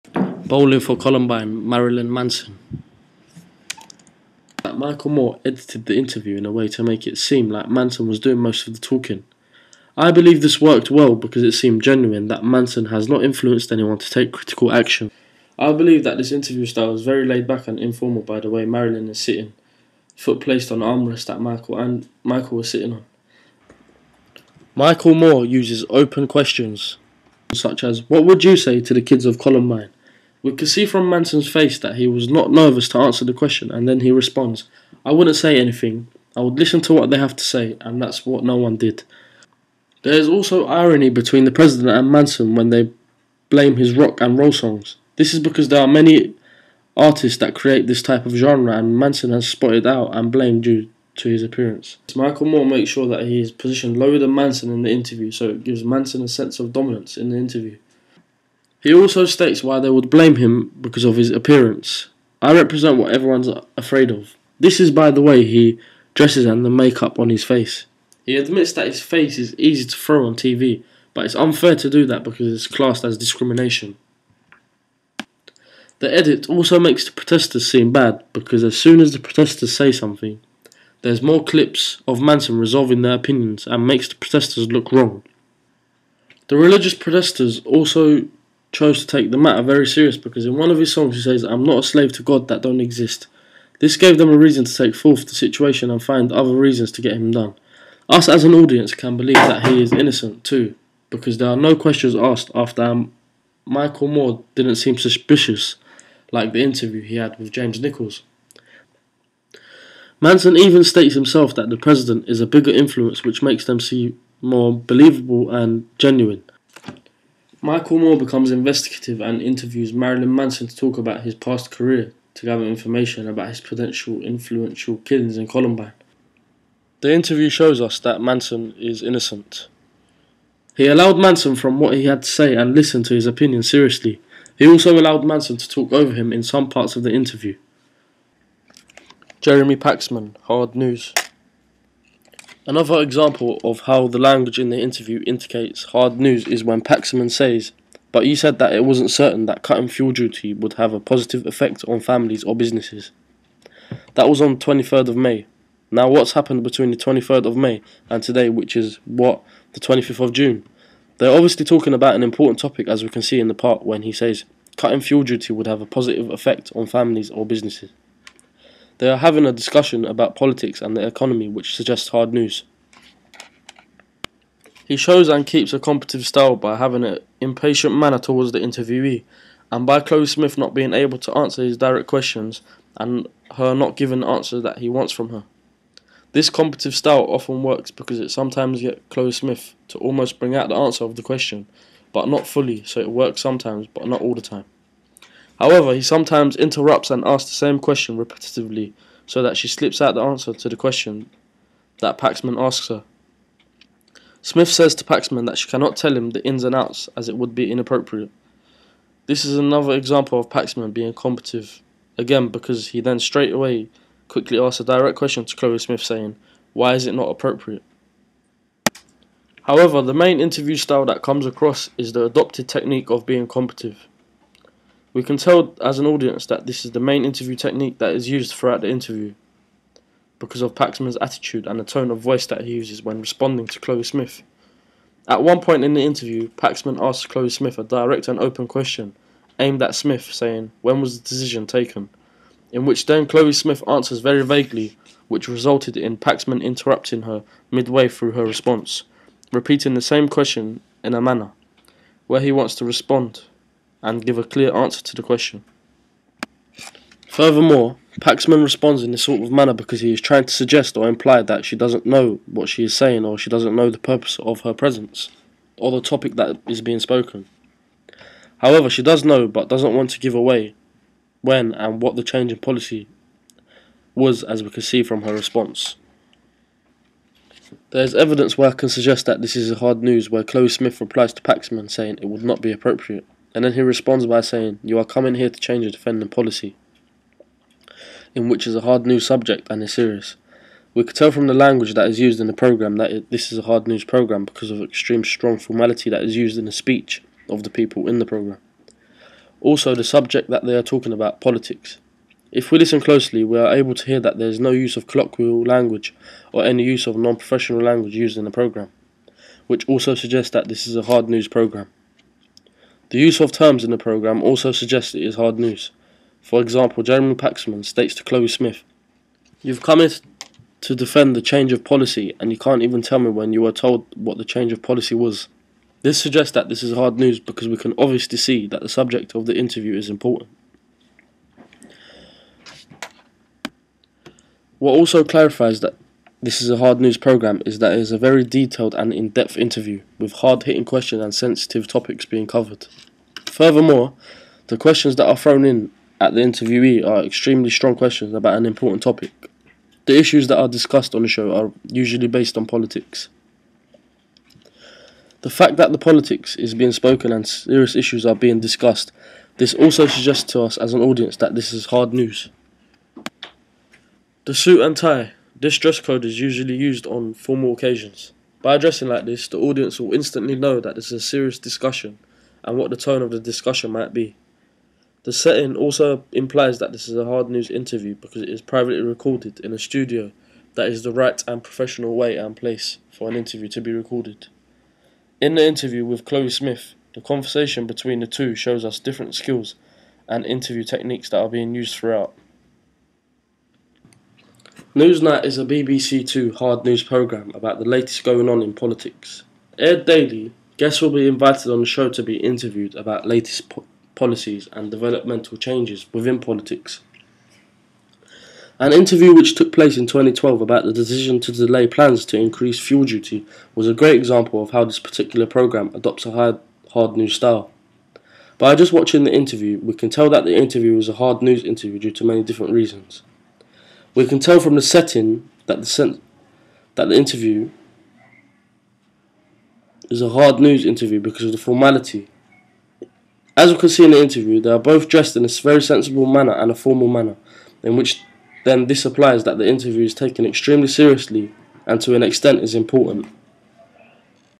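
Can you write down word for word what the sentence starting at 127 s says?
The interview shows us that Manson is innocent.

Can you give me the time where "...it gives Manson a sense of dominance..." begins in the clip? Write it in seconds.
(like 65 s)
55 s.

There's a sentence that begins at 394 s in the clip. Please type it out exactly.
Newsnight is a BBC Two hard news programme about the latest going on in politics.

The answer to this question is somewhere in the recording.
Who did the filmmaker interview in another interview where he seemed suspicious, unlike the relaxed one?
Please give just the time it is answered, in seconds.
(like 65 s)
107 s.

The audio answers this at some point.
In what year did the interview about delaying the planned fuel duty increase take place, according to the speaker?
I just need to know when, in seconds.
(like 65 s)
410 s.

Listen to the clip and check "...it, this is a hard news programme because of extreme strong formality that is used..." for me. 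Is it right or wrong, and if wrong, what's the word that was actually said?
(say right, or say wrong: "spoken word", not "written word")
right.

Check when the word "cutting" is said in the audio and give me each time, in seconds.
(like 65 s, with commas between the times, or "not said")
149 s, 164 s.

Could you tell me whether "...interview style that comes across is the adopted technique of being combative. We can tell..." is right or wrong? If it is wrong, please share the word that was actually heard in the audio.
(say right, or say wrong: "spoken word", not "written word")
right.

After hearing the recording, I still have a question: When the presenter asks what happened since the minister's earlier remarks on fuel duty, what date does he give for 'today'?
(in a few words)
25 June.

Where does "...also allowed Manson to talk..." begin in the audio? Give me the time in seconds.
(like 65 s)
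134 s.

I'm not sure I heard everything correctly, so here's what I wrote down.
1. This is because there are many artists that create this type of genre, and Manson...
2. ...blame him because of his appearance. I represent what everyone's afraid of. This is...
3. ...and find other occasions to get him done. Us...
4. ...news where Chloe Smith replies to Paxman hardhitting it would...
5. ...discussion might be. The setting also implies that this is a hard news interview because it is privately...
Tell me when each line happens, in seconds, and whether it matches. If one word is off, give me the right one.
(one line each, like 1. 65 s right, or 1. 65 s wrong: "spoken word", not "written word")
1. 45 s right
2. 60 s right
3. 95 s wrong: "reasons", not "occasions"
4. 280 s wrong: "saying", not "hardhitting"
5. 373 s right.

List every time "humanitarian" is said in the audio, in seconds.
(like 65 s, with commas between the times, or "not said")
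not said.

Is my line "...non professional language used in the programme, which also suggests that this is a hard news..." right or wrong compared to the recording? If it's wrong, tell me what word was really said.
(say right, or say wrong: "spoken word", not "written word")
right.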